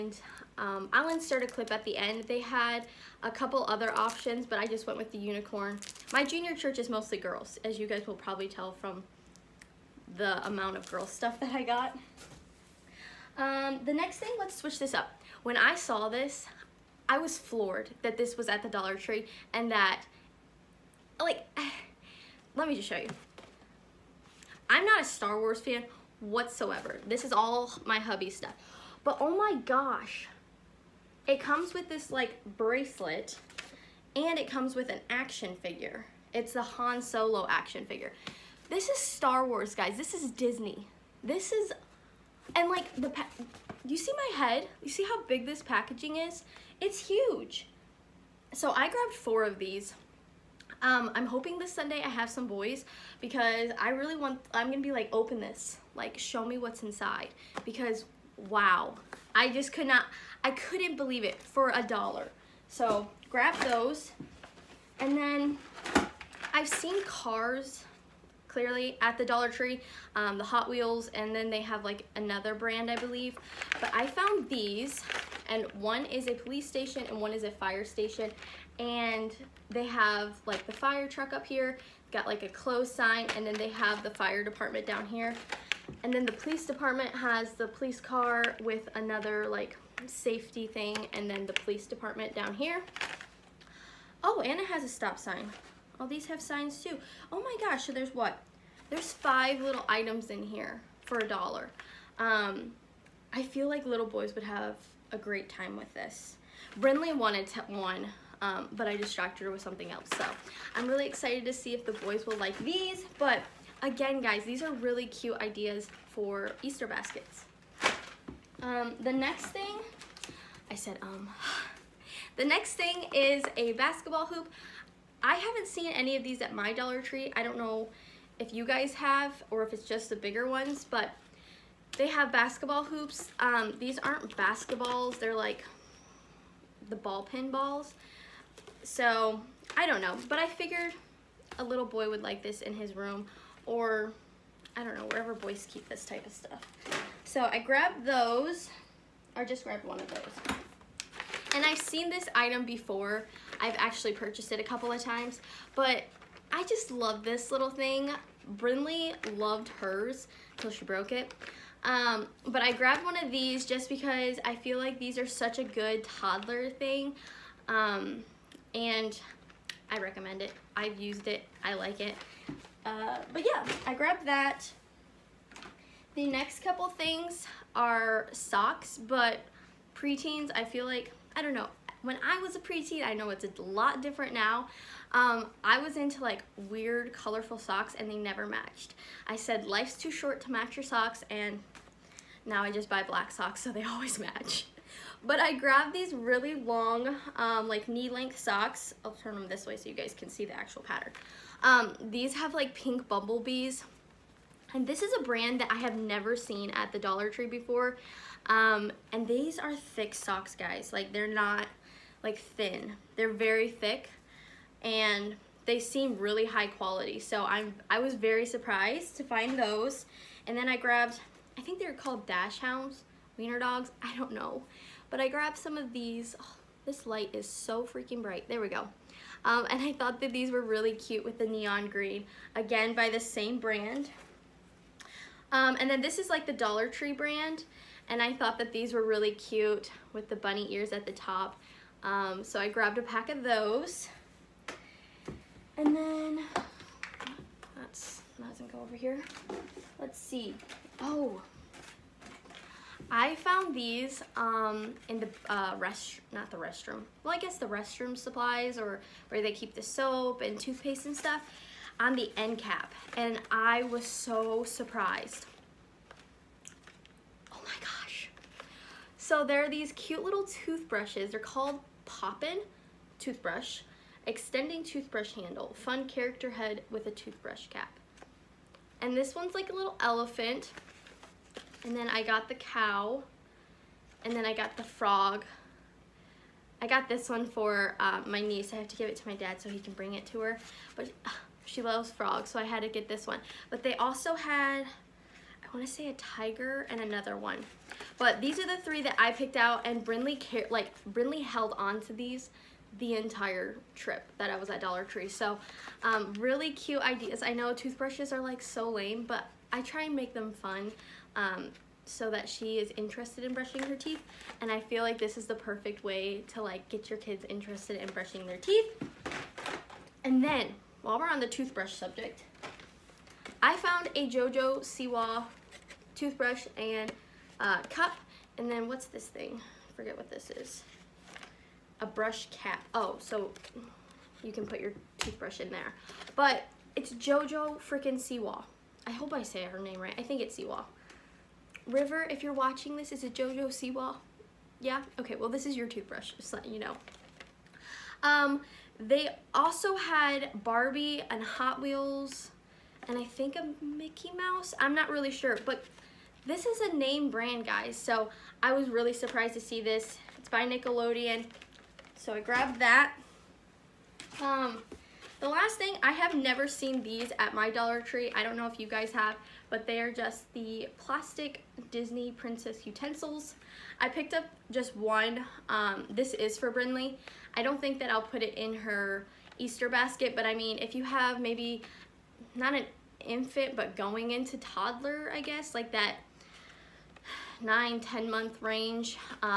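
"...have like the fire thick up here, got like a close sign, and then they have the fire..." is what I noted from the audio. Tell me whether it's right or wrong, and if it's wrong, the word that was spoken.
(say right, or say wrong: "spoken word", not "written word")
wrong: "truck", not "thick".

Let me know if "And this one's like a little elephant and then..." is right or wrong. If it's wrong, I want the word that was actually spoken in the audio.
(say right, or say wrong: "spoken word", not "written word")
right.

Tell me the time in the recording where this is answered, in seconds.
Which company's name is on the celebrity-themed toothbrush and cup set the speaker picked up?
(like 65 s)
360 s.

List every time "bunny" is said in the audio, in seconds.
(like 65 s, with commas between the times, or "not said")
240 s.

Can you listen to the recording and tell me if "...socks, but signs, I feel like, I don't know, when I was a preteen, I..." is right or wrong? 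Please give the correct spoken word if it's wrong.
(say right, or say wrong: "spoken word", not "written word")
wrong: "preteens", not "signs".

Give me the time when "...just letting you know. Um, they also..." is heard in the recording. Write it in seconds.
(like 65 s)
346 s.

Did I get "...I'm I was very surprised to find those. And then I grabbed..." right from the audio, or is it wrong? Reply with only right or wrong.
right.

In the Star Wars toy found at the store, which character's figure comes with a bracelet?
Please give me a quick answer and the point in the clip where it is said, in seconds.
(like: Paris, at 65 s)
Han Solo, at 36 s.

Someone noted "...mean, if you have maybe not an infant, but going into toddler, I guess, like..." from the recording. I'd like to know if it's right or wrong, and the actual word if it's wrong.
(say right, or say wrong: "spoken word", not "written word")
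right.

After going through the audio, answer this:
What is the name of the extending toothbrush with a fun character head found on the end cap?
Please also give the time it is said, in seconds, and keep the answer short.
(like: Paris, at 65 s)
Poppin toothbrush, at 272 s.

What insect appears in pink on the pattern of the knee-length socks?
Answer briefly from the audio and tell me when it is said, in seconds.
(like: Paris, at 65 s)
Bumblebees, at 203 s.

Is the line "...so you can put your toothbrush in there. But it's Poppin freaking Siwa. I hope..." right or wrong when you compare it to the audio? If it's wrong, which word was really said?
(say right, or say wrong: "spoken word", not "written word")
wrong: "JoJo", not "Poppin".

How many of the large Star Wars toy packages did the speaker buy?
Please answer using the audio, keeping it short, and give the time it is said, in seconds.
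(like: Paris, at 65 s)
4, at 49 s.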